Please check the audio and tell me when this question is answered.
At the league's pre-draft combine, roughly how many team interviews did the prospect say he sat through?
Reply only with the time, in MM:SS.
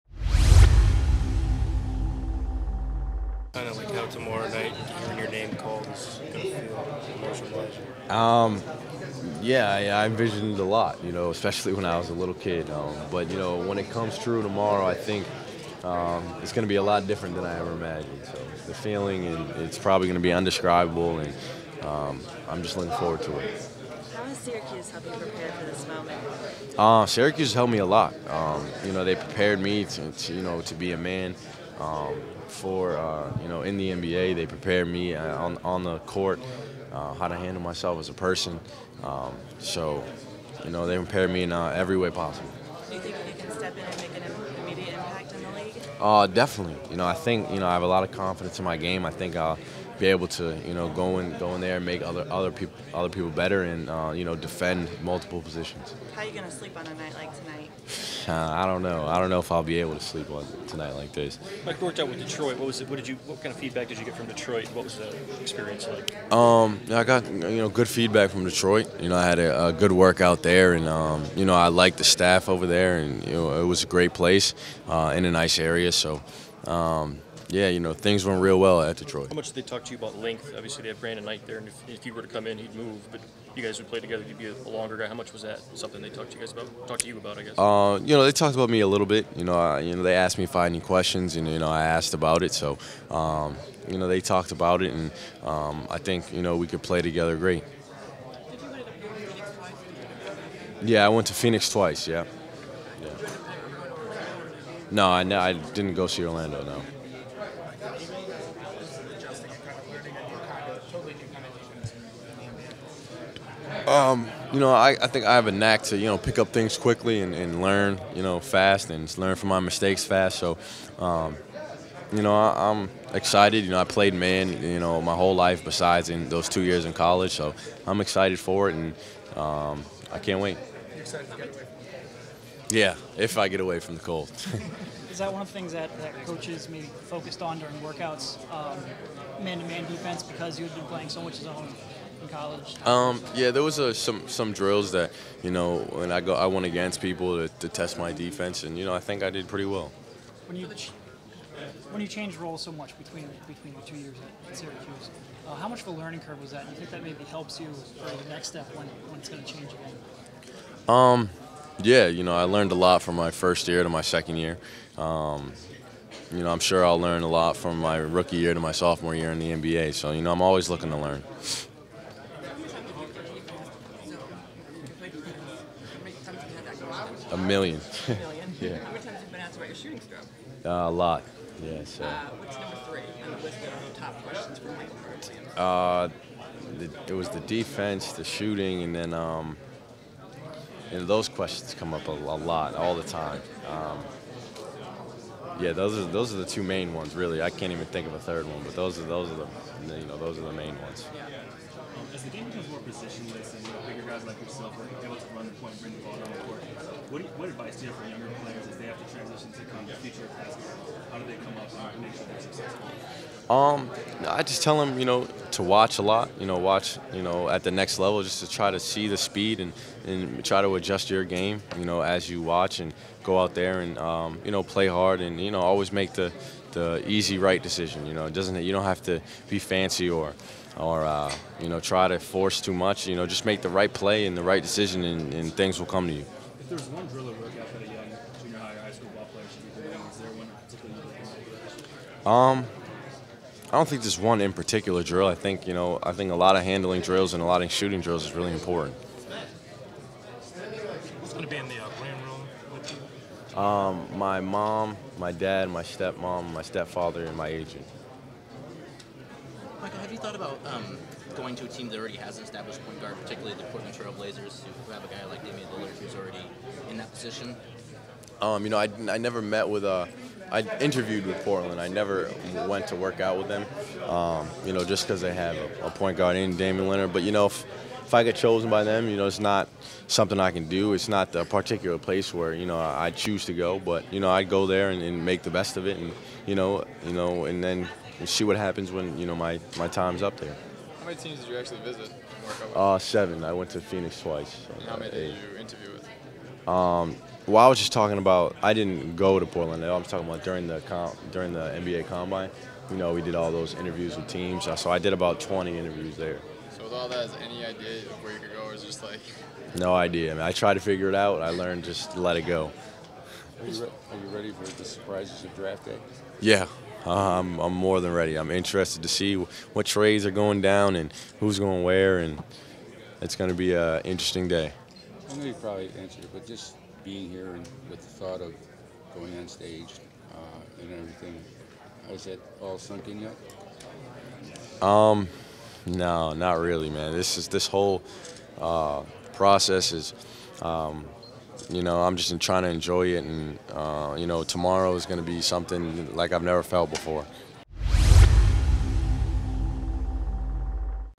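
05:05.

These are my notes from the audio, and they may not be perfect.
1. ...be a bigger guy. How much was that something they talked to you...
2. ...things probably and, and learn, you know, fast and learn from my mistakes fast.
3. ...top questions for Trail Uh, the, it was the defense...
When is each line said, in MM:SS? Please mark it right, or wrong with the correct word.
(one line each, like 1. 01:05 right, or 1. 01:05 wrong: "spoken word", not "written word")
1. 01:24 wrong: "longer", not "bigger"
2. 01:56 wrong: "quickly", not "probably"
3. 03:03 wrong: "Michael", not "Trail".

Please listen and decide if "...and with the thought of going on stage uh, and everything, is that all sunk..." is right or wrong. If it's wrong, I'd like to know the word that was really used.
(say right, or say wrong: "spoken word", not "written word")
right.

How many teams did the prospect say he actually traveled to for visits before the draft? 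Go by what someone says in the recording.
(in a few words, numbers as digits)
7.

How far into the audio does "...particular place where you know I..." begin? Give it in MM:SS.
04:41.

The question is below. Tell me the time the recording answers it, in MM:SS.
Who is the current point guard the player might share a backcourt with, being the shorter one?
01:21.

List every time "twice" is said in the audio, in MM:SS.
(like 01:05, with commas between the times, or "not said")
01:41, 04:54.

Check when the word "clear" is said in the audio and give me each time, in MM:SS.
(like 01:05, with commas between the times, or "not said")
not said.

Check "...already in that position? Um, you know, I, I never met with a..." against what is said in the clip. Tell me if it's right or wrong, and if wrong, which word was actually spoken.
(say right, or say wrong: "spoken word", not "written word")
right.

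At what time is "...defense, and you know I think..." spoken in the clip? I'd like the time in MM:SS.
02:28.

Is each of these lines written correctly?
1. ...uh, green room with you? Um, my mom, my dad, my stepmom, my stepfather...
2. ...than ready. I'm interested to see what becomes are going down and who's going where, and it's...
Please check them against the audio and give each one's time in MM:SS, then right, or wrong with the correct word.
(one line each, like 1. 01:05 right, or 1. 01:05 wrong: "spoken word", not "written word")
1. 04:11 right
2. 05:18 wrong: "trades", not "becomes".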